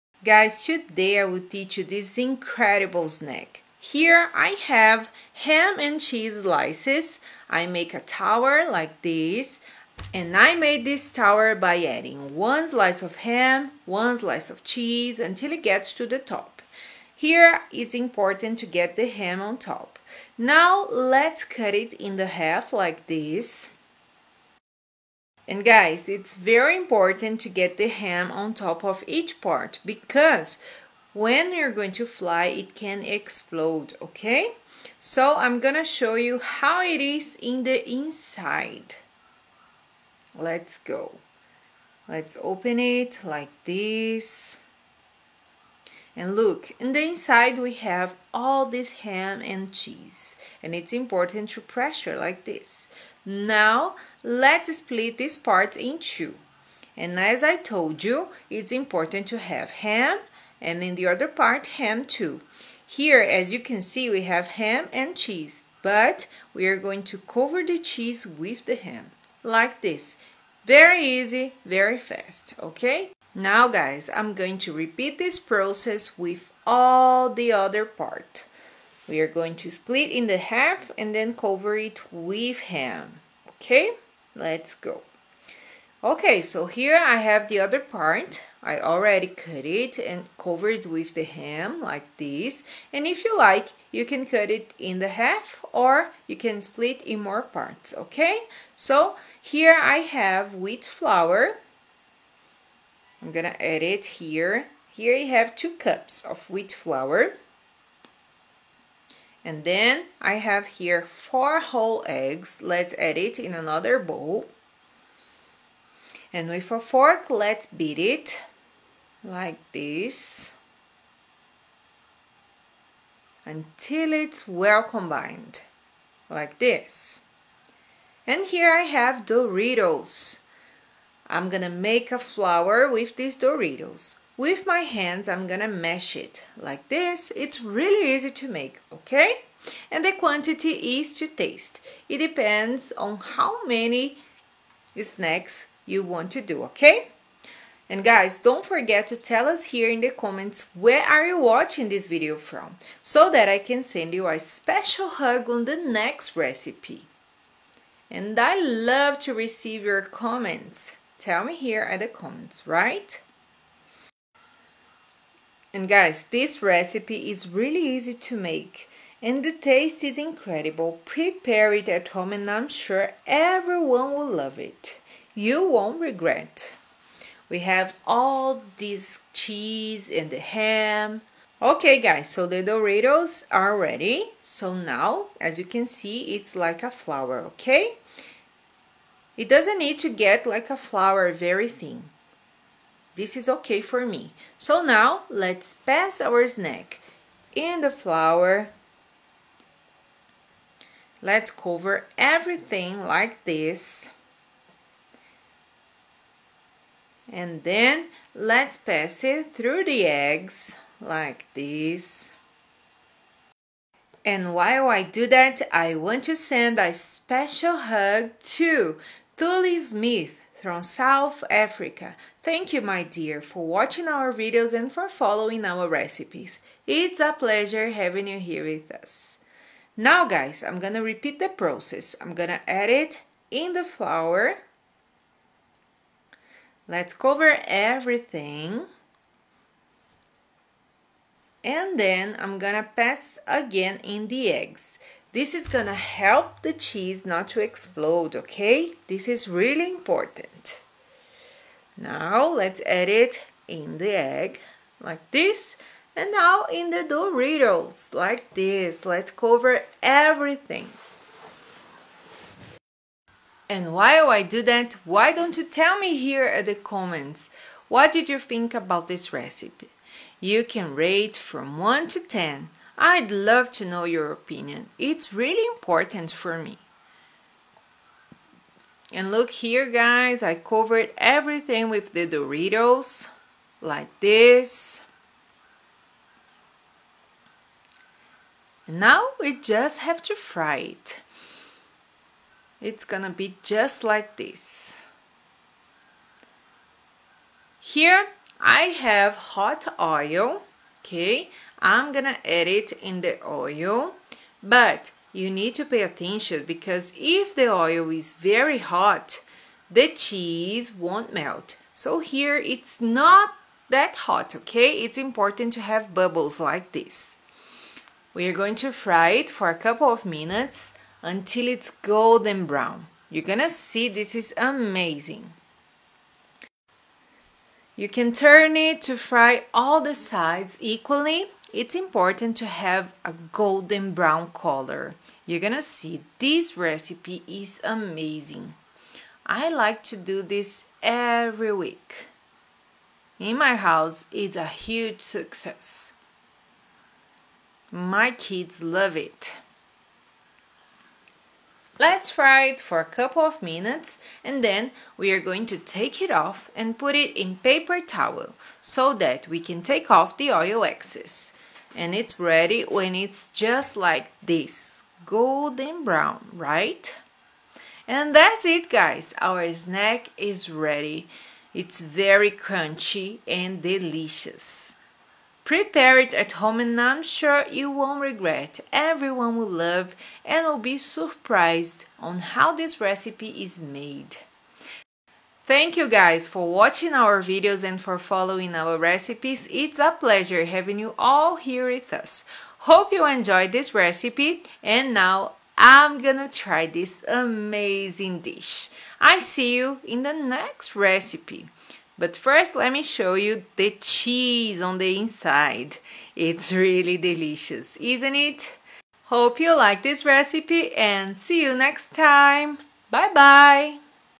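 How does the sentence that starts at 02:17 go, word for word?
It's really easy to make, okay?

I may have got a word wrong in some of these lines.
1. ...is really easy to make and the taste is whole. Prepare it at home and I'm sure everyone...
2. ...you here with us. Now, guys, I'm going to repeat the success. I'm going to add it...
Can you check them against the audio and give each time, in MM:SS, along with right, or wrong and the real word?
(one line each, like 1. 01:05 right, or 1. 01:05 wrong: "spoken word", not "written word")
1. 02:47 wrong: "incredible", not "whole"
2. 03:48 wrong: "process", not "success".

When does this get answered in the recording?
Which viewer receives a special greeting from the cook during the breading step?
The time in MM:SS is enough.
03:39.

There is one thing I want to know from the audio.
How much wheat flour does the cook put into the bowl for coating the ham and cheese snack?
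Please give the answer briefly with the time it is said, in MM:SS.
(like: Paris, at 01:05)
2 cups, at 01:45.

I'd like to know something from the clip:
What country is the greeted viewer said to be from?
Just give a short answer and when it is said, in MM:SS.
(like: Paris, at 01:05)
South Africa, at 03:40.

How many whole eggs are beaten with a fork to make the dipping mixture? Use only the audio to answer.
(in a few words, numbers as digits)
4.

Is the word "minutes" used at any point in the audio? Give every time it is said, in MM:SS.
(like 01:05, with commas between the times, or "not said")
05:20, 05:53.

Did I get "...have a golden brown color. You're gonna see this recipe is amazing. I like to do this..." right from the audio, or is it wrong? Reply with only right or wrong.
right.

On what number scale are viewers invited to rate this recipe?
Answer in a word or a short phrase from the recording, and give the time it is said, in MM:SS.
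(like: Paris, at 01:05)
1 to 10, at 04:31.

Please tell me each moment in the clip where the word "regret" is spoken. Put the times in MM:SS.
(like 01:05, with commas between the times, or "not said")
02:56, 06:18.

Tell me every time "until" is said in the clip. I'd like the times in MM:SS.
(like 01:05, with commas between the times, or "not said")
00:15, 02:03, 05:21.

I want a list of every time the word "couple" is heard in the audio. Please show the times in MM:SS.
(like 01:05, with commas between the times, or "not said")
05:19, 05:53.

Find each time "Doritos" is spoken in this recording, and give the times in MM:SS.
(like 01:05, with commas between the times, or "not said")
02:09, 02:13, 03:02, 04:17, 04:42.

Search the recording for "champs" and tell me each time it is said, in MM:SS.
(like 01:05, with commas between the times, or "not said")
not said.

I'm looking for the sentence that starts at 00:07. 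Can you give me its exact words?
I make a tower like this.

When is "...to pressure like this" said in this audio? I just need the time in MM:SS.
00:51.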